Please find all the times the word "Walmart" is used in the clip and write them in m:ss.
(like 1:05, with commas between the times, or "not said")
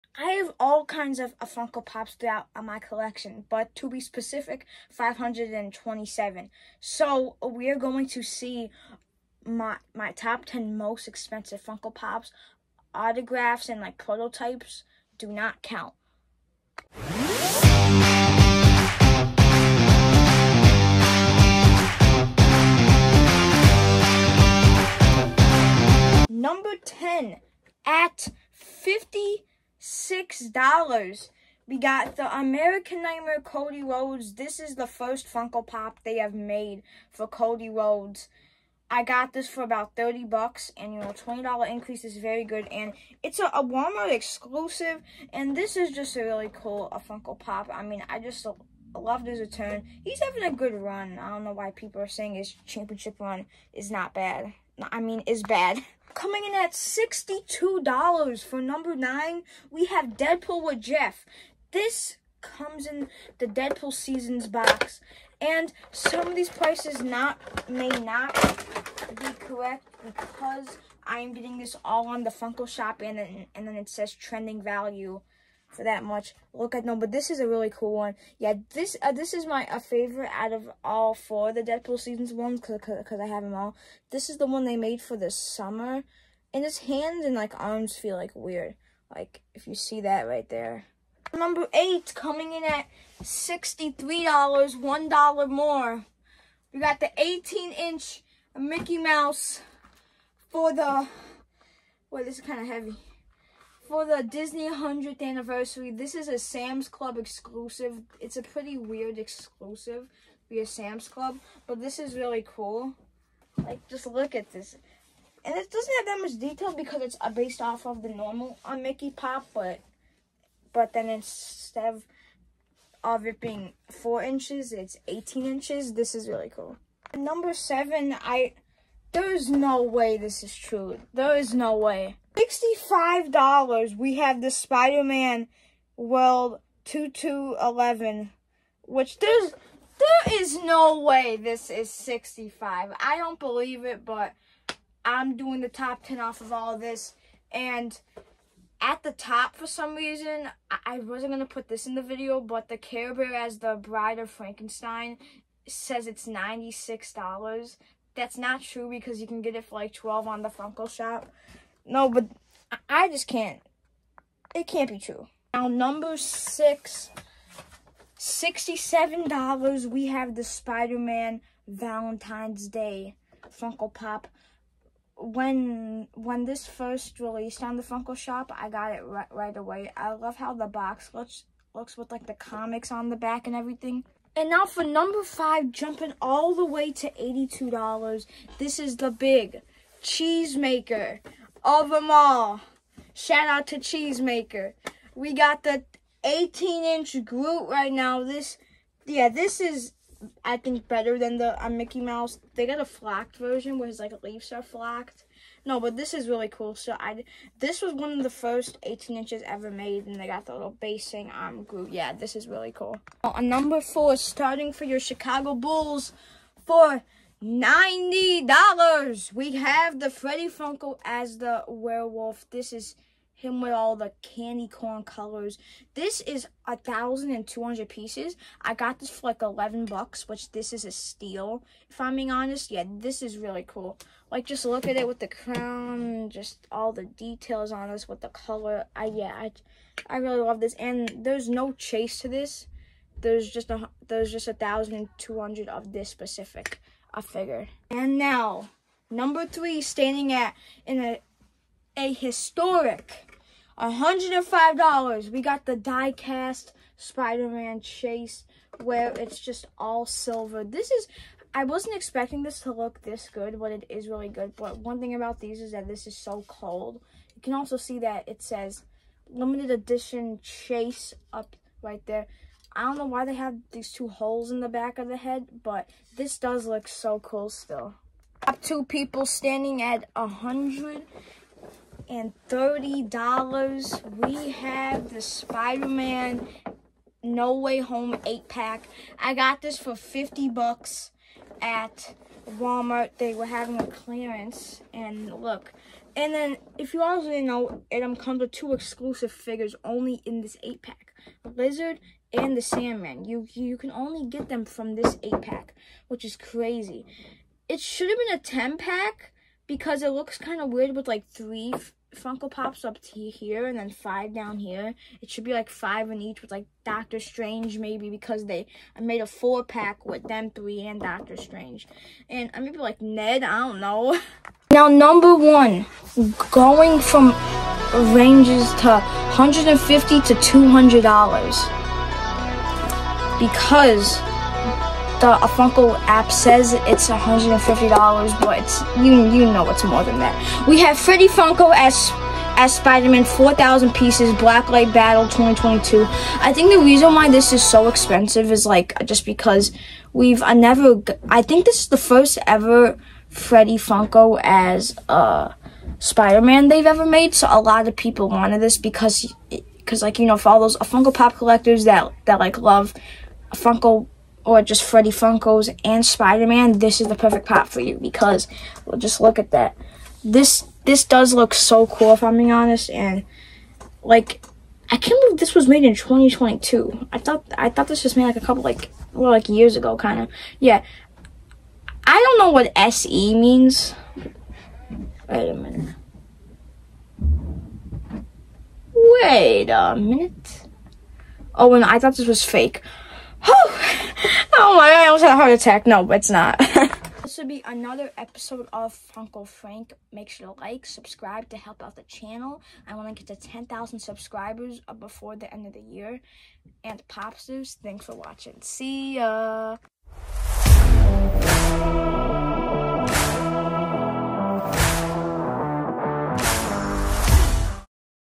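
0:43, 4:52.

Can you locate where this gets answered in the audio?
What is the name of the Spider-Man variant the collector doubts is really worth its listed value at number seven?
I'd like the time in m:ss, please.
2:14.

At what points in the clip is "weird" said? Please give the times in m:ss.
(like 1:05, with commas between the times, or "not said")
1:28, 1:48, 5:10.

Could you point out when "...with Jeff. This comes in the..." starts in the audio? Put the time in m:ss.
1:00.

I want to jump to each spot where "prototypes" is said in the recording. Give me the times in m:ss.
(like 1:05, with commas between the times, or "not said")
0:13.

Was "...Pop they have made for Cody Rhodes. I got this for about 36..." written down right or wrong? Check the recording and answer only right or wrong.
wrong.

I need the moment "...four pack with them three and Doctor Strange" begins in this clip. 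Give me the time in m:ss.
5:19.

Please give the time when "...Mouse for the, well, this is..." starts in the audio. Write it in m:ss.
1:38.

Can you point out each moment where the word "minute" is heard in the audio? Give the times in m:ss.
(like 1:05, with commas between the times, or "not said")
6:25, 6:29.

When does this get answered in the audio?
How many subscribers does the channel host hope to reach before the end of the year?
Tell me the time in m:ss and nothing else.
6:43.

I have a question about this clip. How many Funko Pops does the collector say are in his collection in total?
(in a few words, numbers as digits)
527.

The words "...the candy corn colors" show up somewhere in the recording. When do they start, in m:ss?
3:43.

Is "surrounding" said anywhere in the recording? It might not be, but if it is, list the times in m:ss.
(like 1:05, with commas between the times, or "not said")
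not said.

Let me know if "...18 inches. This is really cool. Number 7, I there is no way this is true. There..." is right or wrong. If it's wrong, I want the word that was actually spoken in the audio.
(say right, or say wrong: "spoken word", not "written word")
right.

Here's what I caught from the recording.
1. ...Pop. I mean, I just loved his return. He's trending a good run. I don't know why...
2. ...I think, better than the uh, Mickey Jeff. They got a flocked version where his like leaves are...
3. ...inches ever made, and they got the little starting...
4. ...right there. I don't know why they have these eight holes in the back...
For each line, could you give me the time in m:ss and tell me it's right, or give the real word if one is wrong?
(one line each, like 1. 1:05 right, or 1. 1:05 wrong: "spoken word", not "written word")
1. 0:47 wrong: "having", not "trending"
2. 3:20 wrong: "Mouse", not "Jeff"
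3. 3:29 wrong: "basing", not "starting"
4. 4:31 wrong: "two", not "eight".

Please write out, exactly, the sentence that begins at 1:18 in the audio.
Yeah, this uh, this is my uh, favorite out of all four the Deadpool seasons ones because I have them all.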